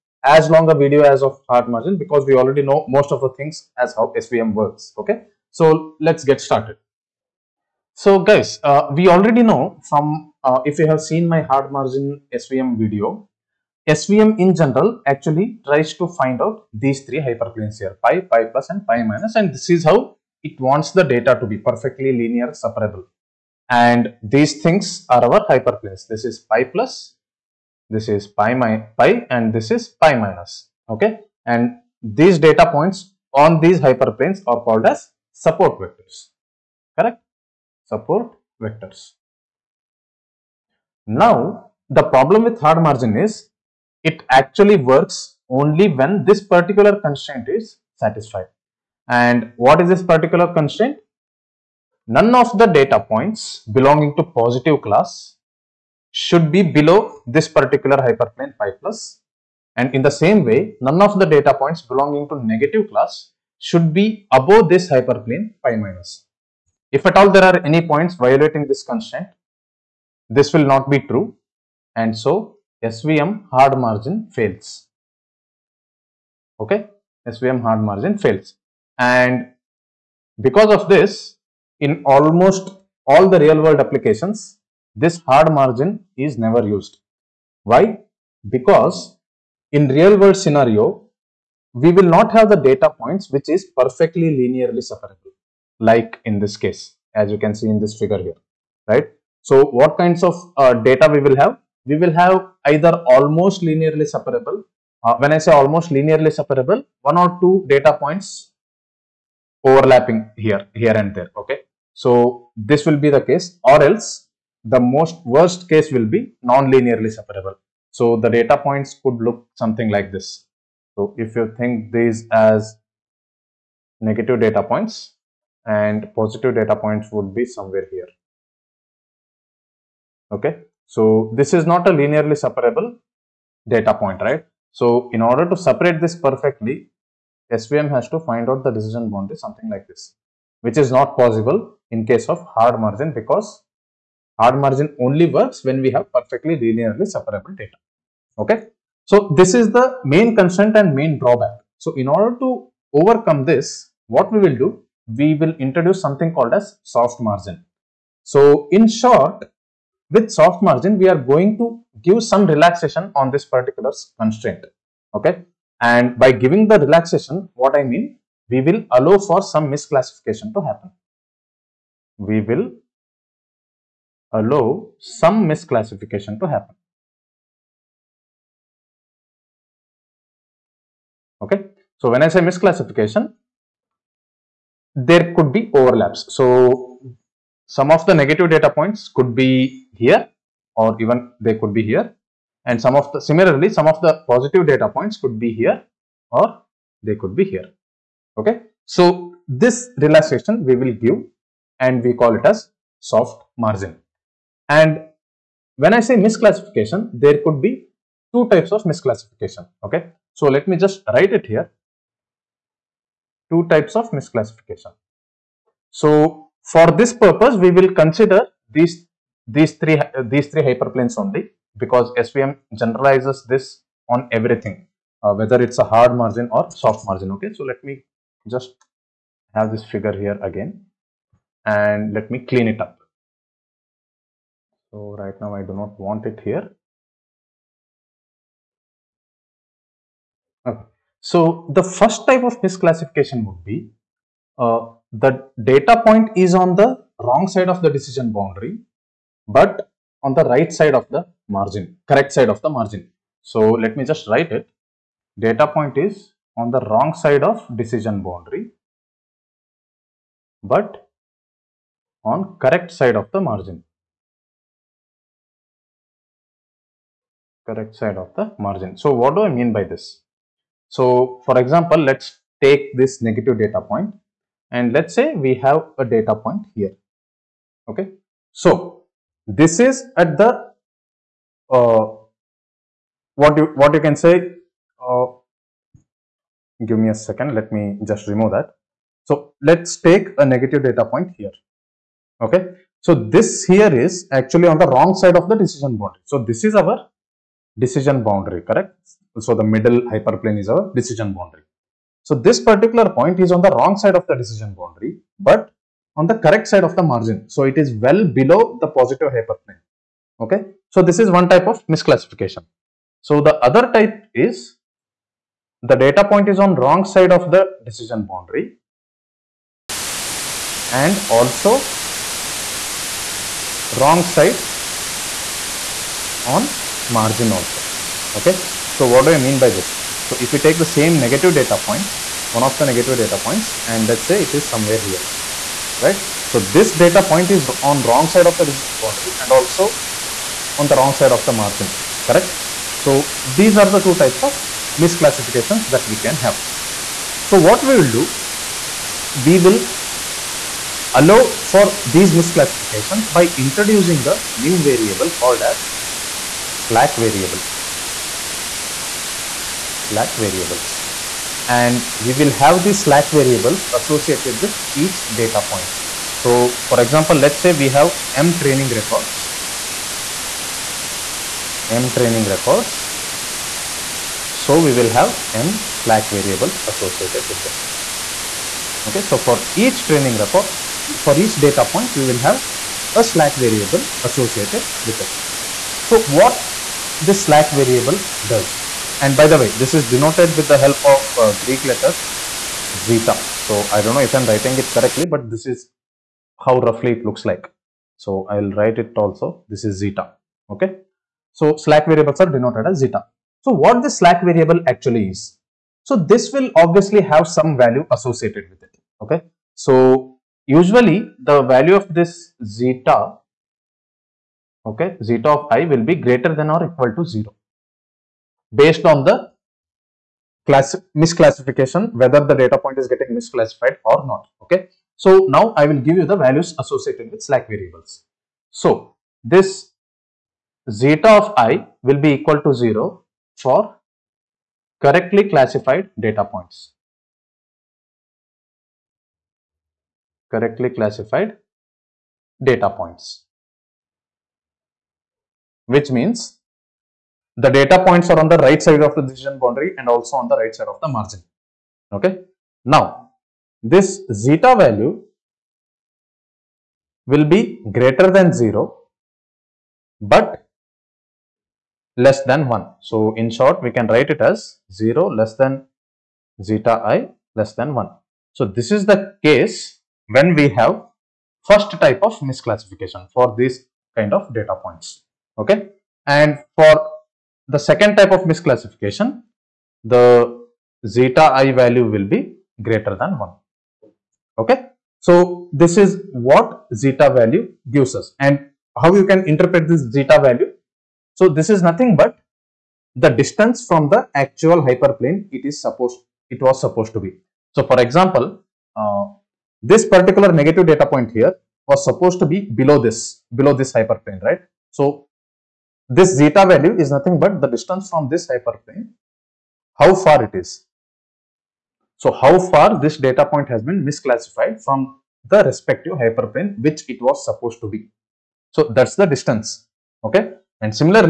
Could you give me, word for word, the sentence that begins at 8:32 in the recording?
So, how far this data point has been misclassified from the respective hyperplane which it was supposed to be.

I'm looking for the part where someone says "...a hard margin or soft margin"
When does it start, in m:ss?
3:45.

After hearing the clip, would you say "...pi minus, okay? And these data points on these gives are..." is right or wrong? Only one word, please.
wrong.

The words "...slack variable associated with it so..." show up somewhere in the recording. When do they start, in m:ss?
6:23.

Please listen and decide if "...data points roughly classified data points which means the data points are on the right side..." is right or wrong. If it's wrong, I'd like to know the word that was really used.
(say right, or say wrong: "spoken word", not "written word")
wrong: "correctly", not "roughly".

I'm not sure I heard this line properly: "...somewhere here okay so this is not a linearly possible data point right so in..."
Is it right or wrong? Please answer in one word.
wrong.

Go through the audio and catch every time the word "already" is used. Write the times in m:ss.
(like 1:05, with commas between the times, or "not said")
0:02, 0:09.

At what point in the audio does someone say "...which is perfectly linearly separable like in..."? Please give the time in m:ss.
1:33.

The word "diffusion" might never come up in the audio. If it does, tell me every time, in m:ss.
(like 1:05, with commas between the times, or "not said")
not said.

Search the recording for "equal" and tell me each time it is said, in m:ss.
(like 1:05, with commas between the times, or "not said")
6:56, 7:12.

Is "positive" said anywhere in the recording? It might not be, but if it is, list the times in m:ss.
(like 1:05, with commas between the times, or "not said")
0:54, 2:06, 3:14, 5:08.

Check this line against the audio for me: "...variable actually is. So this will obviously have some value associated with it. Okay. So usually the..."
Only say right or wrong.
right.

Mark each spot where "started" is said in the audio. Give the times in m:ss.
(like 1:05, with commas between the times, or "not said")
0:06.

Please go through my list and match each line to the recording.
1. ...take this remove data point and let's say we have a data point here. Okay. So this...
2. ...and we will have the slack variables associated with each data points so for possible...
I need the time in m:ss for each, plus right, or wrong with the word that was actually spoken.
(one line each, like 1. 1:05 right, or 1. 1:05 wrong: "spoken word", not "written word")
1. 4:32 wrong: "negative", not "remove"
2. 6:01 wrong: "example", not "possible".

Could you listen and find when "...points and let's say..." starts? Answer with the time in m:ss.
5:33.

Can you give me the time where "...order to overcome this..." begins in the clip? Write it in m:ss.
2:32.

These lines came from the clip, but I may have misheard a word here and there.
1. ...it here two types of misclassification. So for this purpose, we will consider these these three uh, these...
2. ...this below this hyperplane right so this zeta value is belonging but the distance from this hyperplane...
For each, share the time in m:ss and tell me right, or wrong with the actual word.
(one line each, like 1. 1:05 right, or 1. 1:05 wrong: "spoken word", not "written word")
1. 3:31 right
2. 8:23 wrong: "nothing", not "belonging".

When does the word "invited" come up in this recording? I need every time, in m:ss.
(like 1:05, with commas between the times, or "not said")
not said.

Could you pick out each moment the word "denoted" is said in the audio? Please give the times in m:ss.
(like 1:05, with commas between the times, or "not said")
6:30, 6:42.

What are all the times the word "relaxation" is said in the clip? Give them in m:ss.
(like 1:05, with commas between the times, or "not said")
2:42, 2:46, 3:19.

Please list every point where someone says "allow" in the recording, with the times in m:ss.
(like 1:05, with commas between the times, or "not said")
2:48, 2:54, 5:51.